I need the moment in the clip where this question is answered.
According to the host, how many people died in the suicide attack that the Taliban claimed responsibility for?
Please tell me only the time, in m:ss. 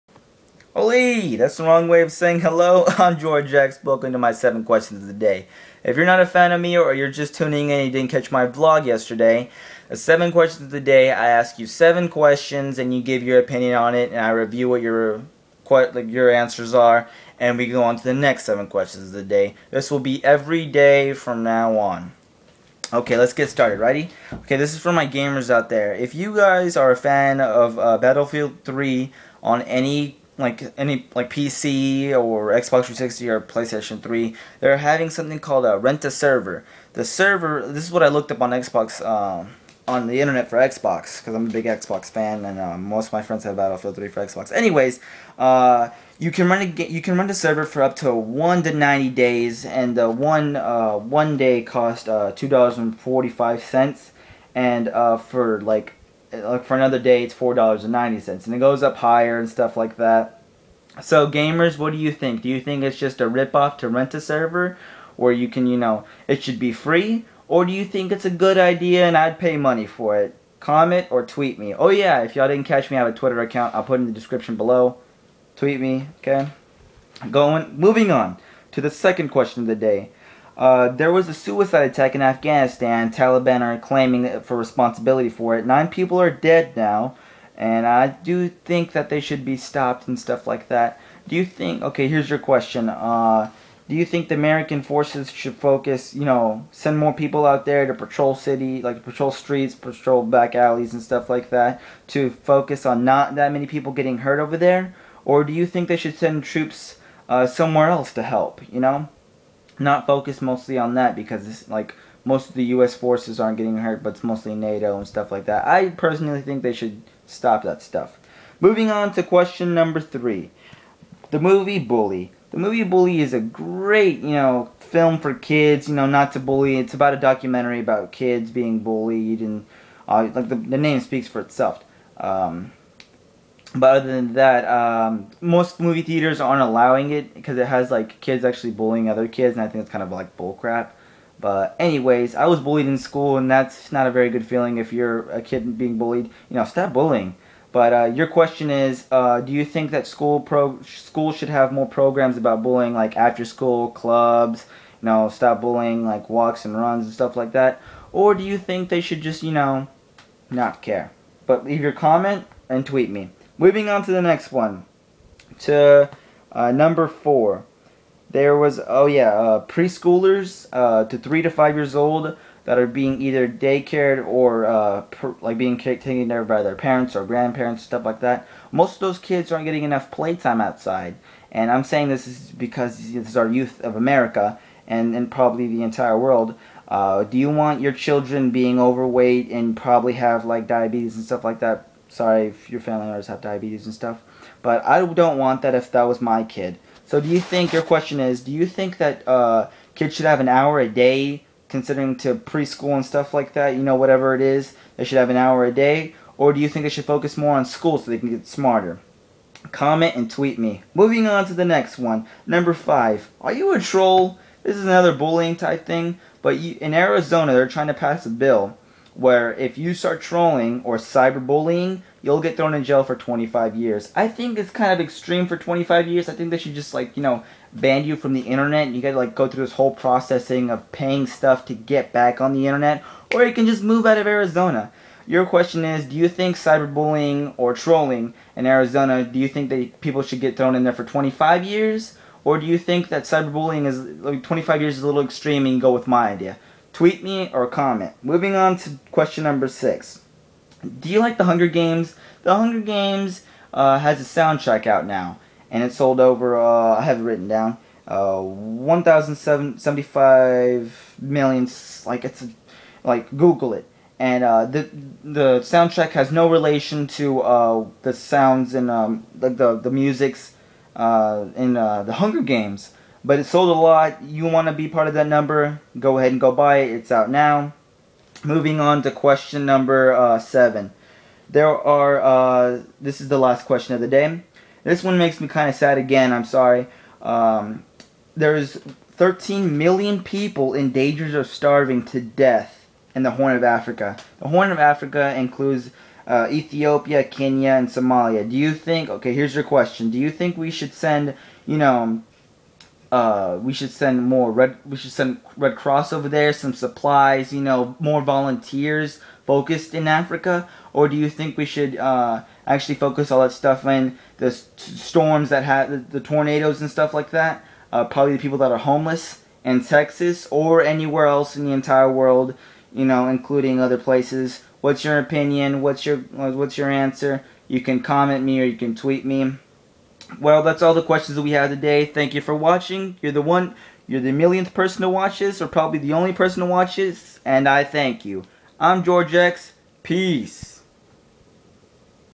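1:25.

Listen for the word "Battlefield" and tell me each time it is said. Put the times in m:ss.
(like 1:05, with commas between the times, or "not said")
0:27, 0:43.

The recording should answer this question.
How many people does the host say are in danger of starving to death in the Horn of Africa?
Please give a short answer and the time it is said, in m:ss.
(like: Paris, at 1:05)
13 million, at 4:49.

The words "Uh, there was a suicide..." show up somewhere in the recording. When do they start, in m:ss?
1:20.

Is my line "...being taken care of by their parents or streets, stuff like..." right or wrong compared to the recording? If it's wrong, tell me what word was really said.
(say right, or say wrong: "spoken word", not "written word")
wrong: "grandparents", not "streets".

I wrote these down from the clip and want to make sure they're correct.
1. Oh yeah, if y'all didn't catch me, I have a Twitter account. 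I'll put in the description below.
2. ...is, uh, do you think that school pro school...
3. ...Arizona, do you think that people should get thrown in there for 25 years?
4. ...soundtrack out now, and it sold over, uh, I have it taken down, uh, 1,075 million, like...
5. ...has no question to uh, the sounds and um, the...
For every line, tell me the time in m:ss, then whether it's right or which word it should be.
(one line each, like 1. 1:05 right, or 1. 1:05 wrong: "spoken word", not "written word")
1. 1:11 right
2. 2:28 right
3. 3:58 right
4. 4:14 wrong: "written", not "taken"
5. 4:26 wrong: "relation", not "question".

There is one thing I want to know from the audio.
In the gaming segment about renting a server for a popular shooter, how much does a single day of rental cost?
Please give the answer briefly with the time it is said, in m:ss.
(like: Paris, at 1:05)
$2.45, at 0:52.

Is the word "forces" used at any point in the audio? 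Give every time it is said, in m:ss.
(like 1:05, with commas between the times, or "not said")
1:34, 1:52.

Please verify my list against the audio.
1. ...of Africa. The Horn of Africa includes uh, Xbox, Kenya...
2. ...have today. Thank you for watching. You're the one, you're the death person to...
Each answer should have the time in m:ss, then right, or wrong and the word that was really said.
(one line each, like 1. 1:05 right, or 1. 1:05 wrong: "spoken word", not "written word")
1. 4:53 wrong: "Ethiopia", not "Xbox"
2. 5:31 wrong: "millionth", not "death".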